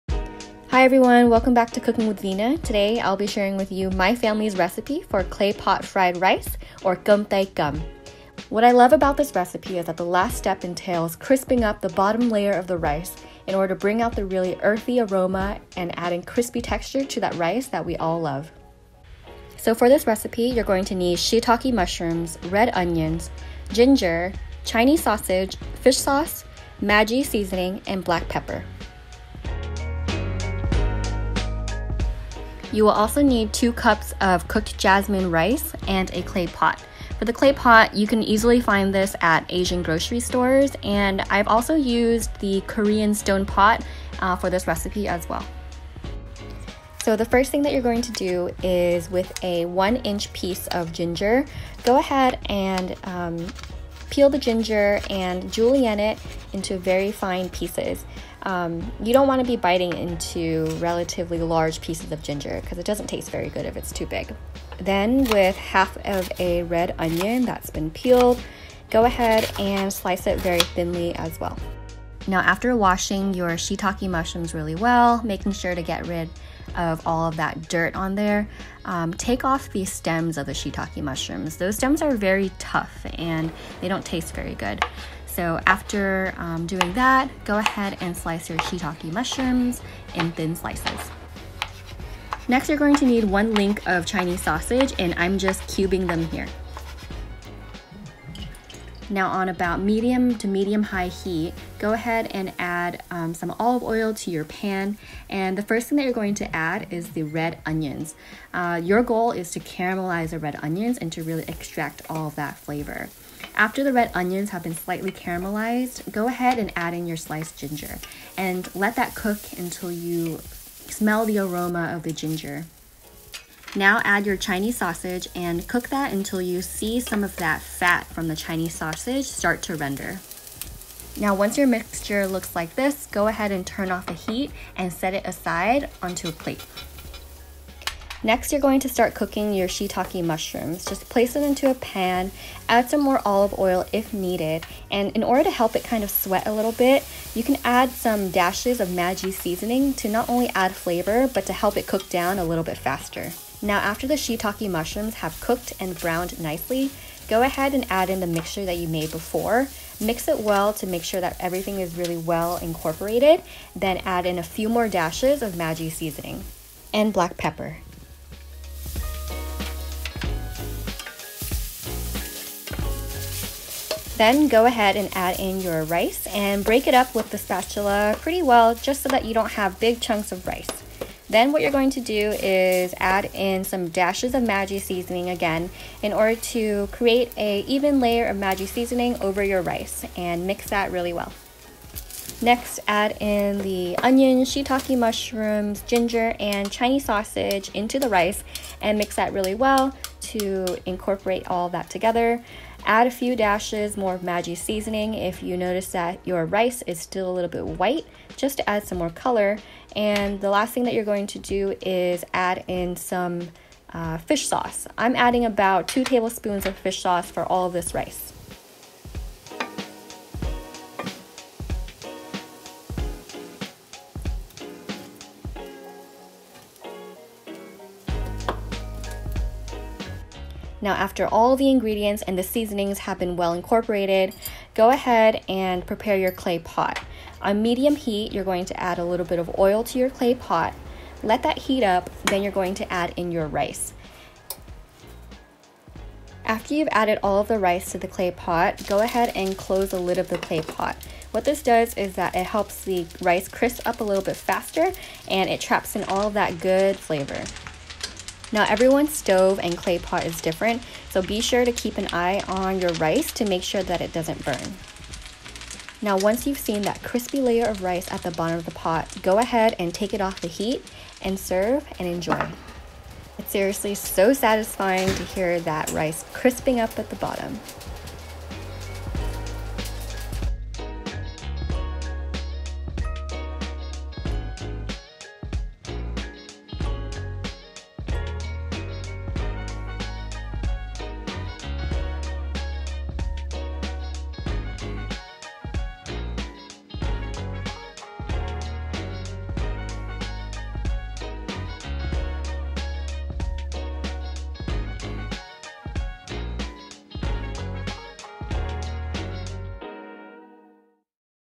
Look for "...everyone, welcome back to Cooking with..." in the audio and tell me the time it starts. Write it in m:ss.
0:00.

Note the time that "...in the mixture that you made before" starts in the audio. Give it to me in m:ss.
2:38.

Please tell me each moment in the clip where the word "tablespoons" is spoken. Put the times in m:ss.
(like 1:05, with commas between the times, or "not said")
3:36.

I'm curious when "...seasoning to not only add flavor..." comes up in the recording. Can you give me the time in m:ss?
2:29.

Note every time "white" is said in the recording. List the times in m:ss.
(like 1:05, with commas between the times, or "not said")
3:27.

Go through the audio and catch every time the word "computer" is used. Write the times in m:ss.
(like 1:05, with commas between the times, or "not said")
not said.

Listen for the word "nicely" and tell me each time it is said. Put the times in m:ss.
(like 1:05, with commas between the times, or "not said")
2:36.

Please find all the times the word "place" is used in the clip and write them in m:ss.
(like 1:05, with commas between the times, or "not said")
2:21.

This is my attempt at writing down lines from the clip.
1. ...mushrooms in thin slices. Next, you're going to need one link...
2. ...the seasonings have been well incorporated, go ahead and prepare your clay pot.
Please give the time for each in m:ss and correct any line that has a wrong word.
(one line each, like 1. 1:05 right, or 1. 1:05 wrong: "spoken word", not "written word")
1. 1:29 right
2. 3:52 right.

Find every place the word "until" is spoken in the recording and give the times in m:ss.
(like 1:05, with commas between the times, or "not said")
1:59, 2:06.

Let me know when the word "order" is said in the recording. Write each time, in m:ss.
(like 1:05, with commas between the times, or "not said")
0:13, 2:25, 3:06.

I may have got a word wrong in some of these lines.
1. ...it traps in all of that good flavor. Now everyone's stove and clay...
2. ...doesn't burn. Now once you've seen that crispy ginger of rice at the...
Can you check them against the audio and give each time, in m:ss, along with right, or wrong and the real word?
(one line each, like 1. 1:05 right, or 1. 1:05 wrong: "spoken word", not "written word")
1. 4:15 right
2. 4:24 wrong: "layer", not "ginger".